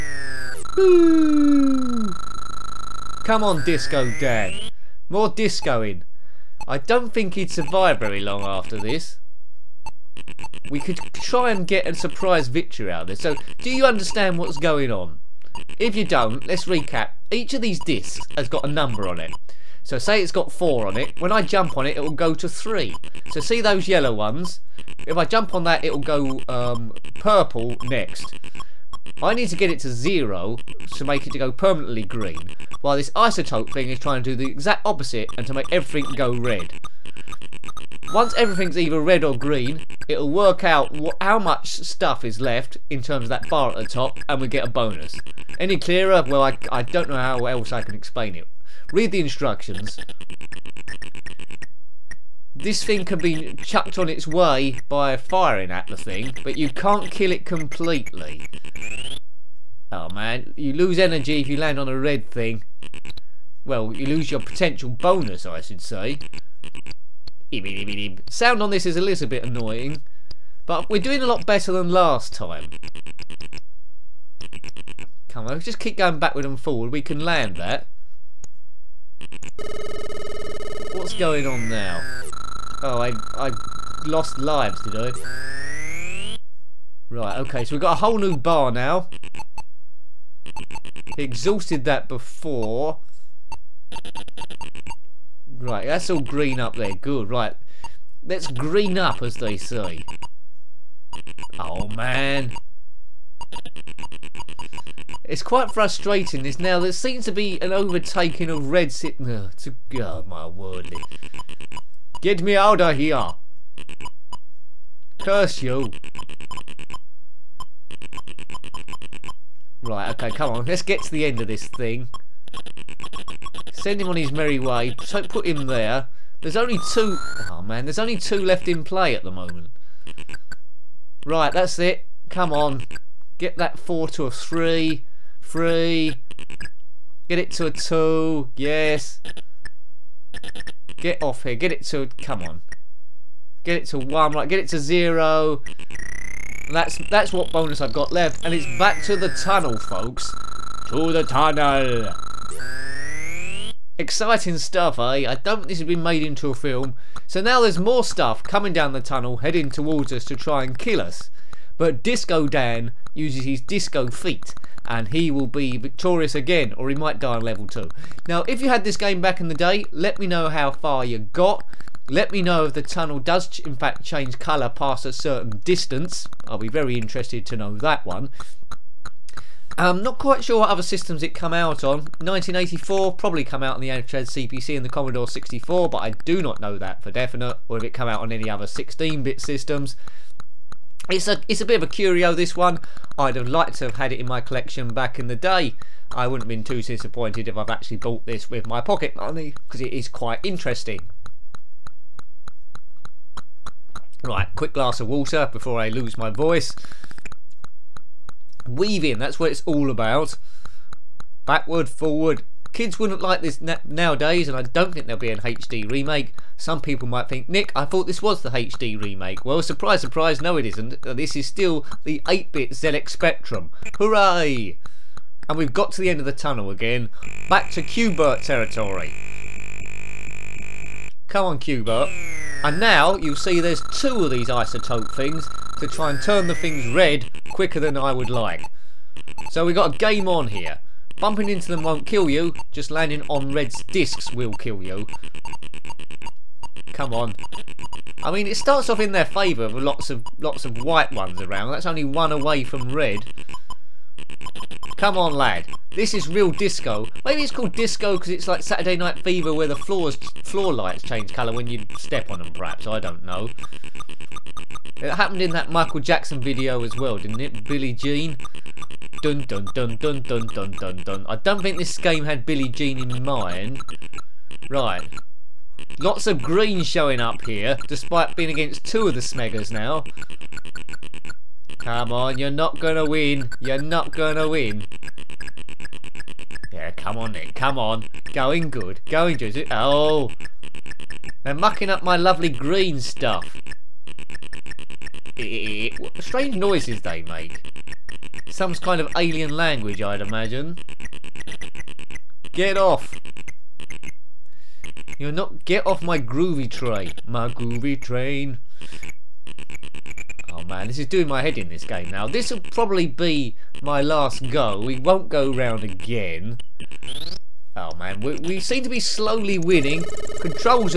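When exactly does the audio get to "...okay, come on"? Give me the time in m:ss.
2:00.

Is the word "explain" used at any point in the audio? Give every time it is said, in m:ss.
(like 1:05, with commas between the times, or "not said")
0:47.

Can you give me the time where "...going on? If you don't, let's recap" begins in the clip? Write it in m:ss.
0:14.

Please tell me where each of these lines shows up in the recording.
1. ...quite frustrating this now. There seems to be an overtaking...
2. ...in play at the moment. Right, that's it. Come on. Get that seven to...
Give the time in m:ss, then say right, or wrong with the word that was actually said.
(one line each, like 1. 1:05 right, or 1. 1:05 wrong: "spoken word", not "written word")
1. 1:45 right
2. 2:08 wrong: "four", not "seven".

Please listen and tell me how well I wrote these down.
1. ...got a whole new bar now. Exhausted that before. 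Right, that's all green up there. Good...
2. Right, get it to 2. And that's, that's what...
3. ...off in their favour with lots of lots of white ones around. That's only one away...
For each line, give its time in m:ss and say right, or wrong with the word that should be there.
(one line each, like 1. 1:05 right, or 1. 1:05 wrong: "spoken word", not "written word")
1. 1:27 right
2. 2:24 wrong: "0", not "2"
3. 4:08 right.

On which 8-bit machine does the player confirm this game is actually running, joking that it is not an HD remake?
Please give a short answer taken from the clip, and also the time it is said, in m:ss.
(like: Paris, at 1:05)
ZX Spectrum, at 3:42.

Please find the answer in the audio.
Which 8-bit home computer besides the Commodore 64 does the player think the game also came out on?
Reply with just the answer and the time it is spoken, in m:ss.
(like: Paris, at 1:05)
Amstrad CPC, at 3:03.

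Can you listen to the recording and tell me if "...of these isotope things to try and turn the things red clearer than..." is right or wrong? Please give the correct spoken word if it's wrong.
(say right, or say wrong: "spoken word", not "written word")
wrong: "quicker", not "clearer".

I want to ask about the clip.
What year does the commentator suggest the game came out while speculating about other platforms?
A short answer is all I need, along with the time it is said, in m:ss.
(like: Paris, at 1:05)
1984, at 3:02.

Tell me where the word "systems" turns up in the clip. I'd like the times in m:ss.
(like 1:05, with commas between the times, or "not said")
3:00, 3:09.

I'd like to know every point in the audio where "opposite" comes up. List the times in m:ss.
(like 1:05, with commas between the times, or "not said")
0:34.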